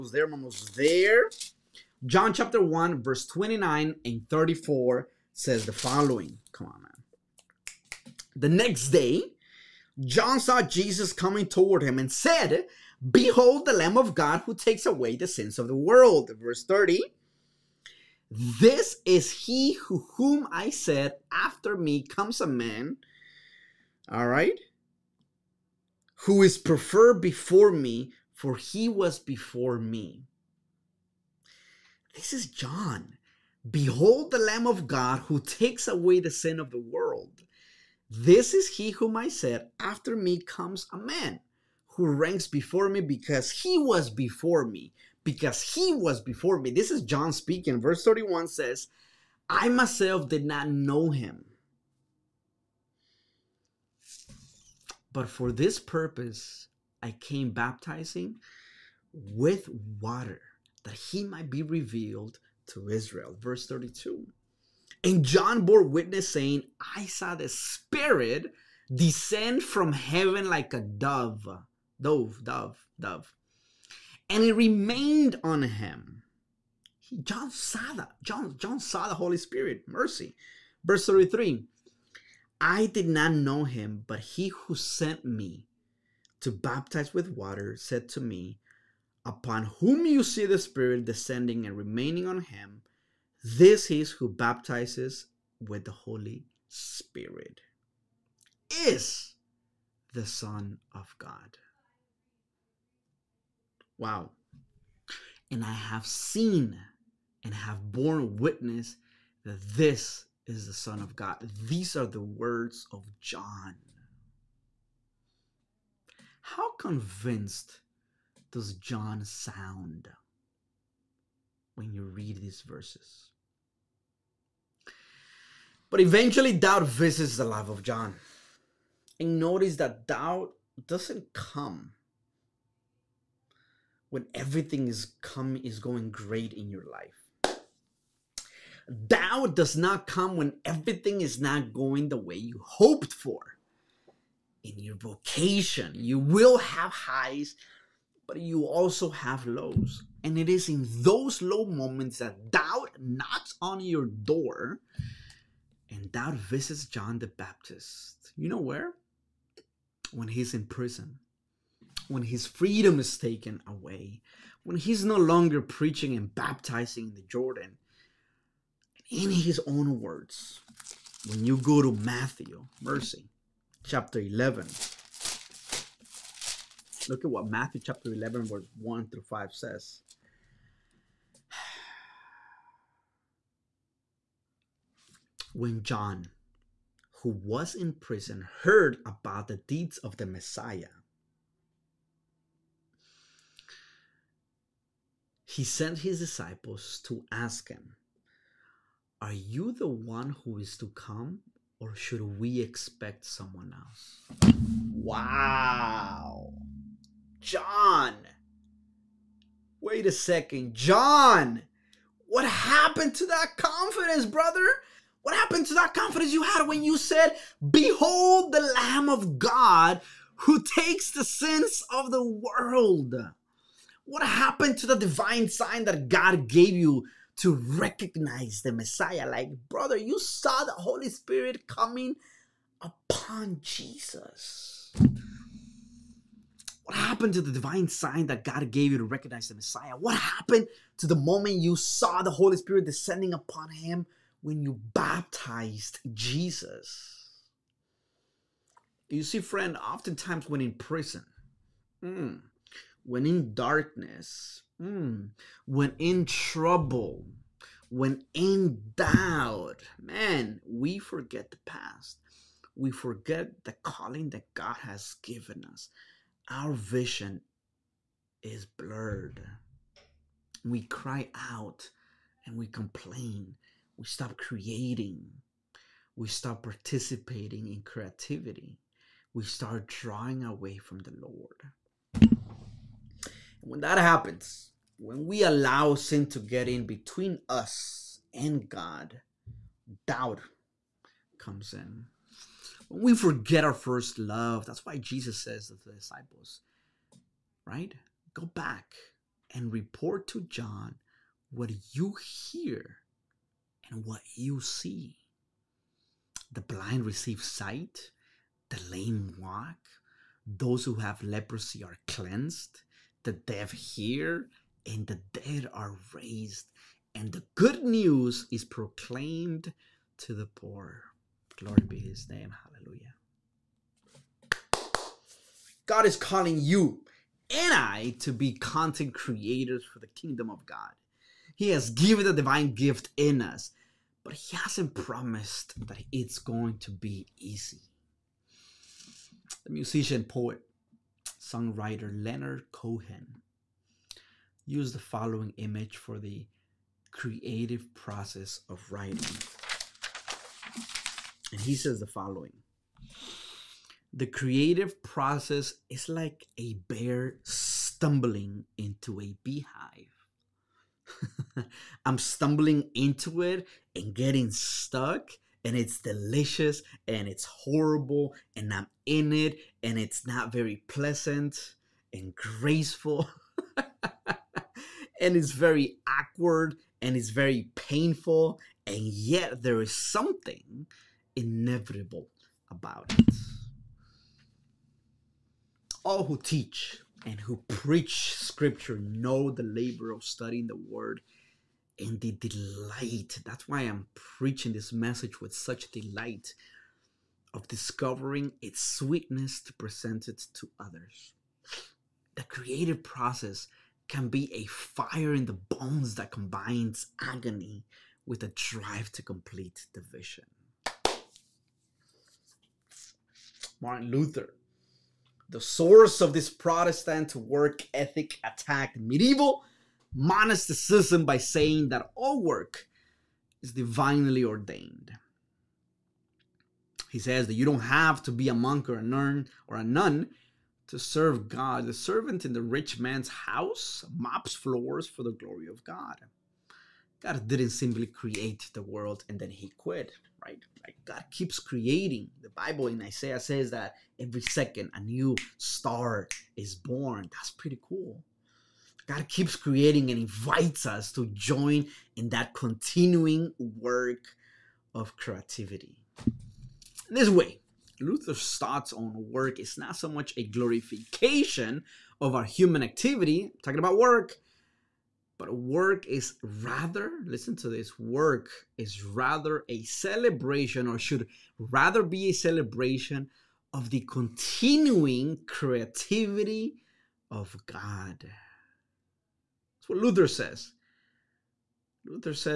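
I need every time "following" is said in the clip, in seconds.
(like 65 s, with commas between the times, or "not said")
5 s, 344 s, 352 s.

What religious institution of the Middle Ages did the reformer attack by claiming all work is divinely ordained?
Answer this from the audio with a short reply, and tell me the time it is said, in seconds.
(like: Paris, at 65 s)
medieval monasticism, at 418 s.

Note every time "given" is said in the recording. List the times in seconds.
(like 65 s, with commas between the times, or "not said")
265 s, 331 s.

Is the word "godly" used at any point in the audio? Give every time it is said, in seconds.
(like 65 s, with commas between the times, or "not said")
not said.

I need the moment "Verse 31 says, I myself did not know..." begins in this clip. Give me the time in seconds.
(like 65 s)
47 s.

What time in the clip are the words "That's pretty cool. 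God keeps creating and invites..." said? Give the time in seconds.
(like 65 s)
447 s.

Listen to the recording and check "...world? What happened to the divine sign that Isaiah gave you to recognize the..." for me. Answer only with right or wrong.
wrong.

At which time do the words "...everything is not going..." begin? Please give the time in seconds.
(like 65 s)
140 s.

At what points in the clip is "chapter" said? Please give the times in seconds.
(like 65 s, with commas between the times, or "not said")
2 s, 173 s, 177 s.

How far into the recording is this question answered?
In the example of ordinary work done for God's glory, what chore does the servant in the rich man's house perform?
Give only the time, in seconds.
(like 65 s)
434 s.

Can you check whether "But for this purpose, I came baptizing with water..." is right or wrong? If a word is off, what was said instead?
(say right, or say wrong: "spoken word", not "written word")
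right.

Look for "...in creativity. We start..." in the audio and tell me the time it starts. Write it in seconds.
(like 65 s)
277 s.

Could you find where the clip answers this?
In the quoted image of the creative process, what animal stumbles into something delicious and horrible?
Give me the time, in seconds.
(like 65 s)
356 s.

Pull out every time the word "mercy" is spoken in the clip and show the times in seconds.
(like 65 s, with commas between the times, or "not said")
79 s, 172 s.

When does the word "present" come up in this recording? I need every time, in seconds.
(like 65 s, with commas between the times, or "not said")
399 s.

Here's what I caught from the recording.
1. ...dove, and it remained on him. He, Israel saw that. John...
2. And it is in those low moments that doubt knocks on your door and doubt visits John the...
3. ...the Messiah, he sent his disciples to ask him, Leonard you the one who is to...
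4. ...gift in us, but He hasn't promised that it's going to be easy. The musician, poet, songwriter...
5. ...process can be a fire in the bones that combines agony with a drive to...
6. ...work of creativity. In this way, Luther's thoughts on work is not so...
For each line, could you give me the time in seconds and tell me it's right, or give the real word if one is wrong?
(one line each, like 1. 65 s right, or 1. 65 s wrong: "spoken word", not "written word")
1. 72 s wrong: "John", not "Israel"
2. 150 s right
3. 190 s wrong: "Are", not "Leonard"
4. 332 s right
5. 403 s right
6. 453 s right.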